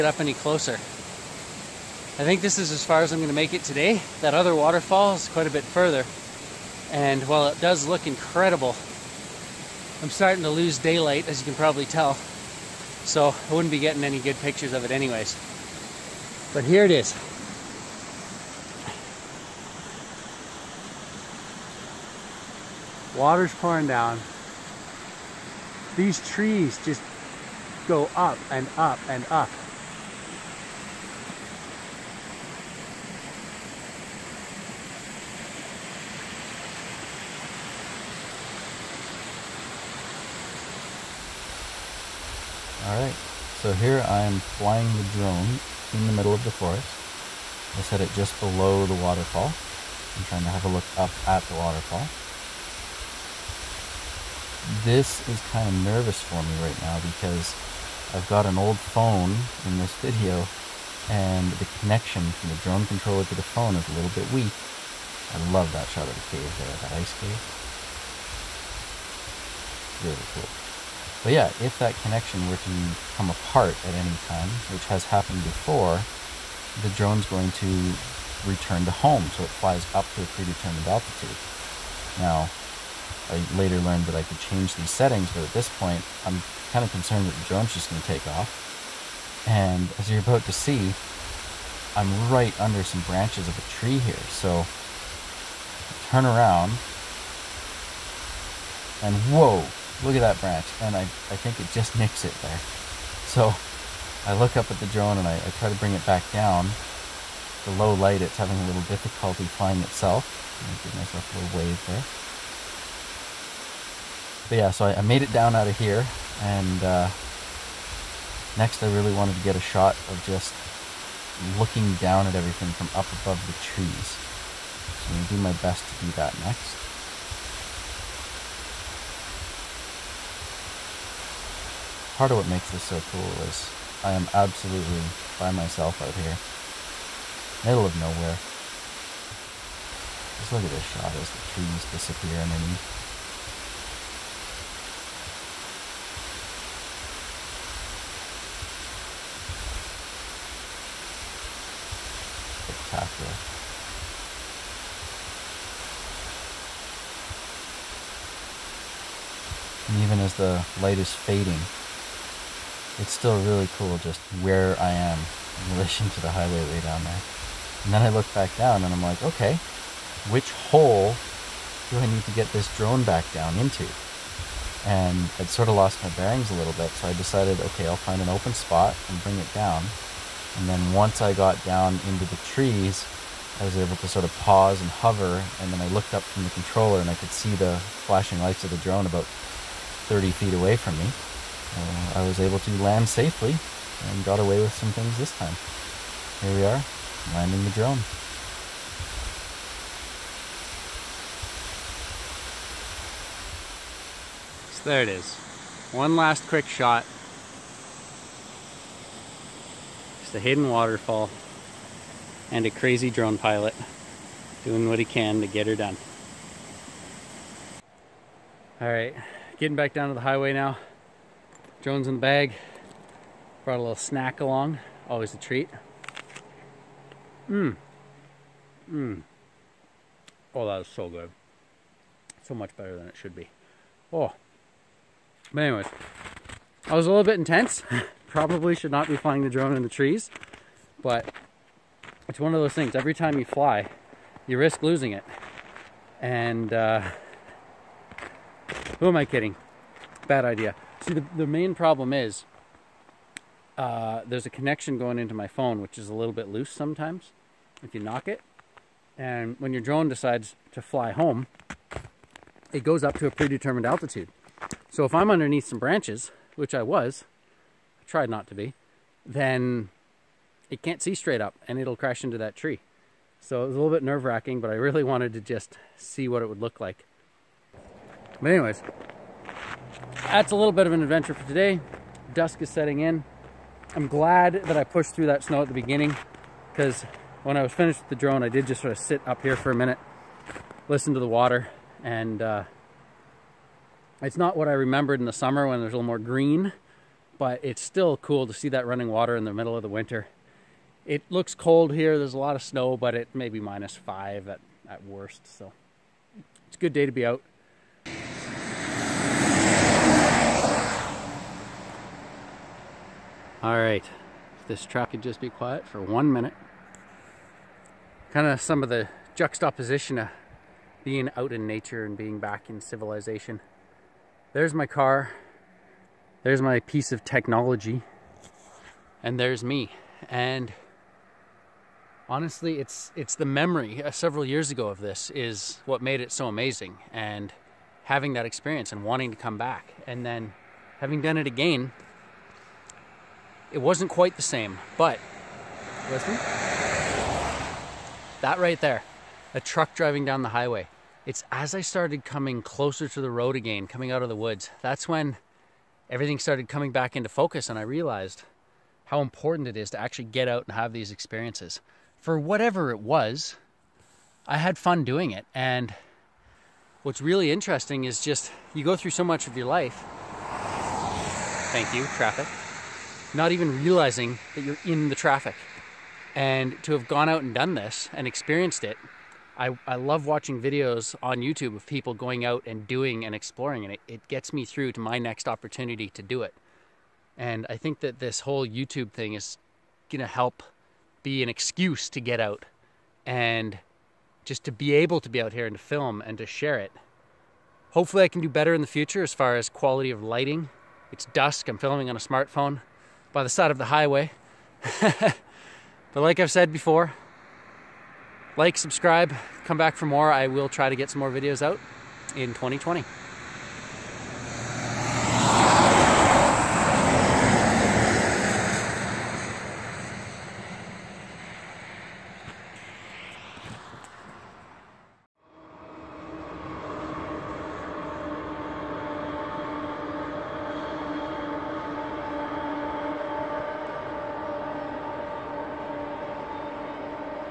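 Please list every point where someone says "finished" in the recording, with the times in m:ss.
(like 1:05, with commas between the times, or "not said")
4:47.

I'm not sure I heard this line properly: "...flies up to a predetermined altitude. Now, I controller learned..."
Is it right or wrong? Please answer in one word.
wrong.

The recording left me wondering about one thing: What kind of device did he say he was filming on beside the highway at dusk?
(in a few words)
smartphone.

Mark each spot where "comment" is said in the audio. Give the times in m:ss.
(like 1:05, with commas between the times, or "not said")
not said.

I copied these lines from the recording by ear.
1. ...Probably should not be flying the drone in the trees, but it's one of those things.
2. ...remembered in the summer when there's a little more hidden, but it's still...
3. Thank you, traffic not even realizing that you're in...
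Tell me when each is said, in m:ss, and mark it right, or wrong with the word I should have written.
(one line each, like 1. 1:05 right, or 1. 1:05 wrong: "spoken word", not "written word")
1. 3:58 right
2. 4:54 wrong: "green", not "hidden"
3. 6:11 right.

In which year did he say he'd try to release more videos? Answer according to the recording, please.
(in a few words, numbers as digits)
2020.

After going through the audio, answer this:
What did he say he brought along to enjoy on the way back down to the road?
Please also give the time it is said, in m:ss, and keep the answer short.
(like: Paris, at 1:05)
a little snack, at 3:43.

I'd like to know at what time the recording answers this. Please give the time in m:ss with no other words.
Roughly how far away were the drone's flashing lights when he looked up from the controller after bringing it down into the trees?
3:10.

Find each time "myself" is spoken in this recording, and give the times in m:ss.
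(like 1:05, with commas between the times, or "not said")
1:50, 2:15.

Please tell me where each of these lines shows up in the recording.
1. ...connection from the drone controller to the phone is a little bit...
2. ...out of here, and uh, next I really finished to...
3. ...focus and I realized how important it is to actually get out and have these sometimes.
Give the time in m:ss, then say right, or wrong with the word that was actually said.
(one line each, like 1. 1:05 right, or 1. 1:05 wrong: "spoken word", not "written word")
1. 1:01 right
2. 1:55 wrong: "wanted", not "finished"
3. 5:57 wrong: "experiences", not "sometimes".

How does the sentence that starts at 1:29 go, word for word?
And as you're about to see, I'm right under some branches of a tree here.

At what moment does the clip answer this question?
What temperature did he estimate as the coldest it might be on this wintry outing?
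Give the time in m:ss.
5:03.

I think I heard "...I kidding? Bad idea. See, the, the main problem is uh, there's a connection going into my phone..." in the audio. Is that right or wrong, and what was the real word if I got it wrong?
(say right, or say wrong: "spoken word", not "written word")
right.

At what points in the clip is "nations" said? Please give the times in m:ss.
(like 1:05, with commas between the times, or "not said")
not said.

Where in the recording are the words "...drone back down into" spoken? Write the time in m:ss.
2:52.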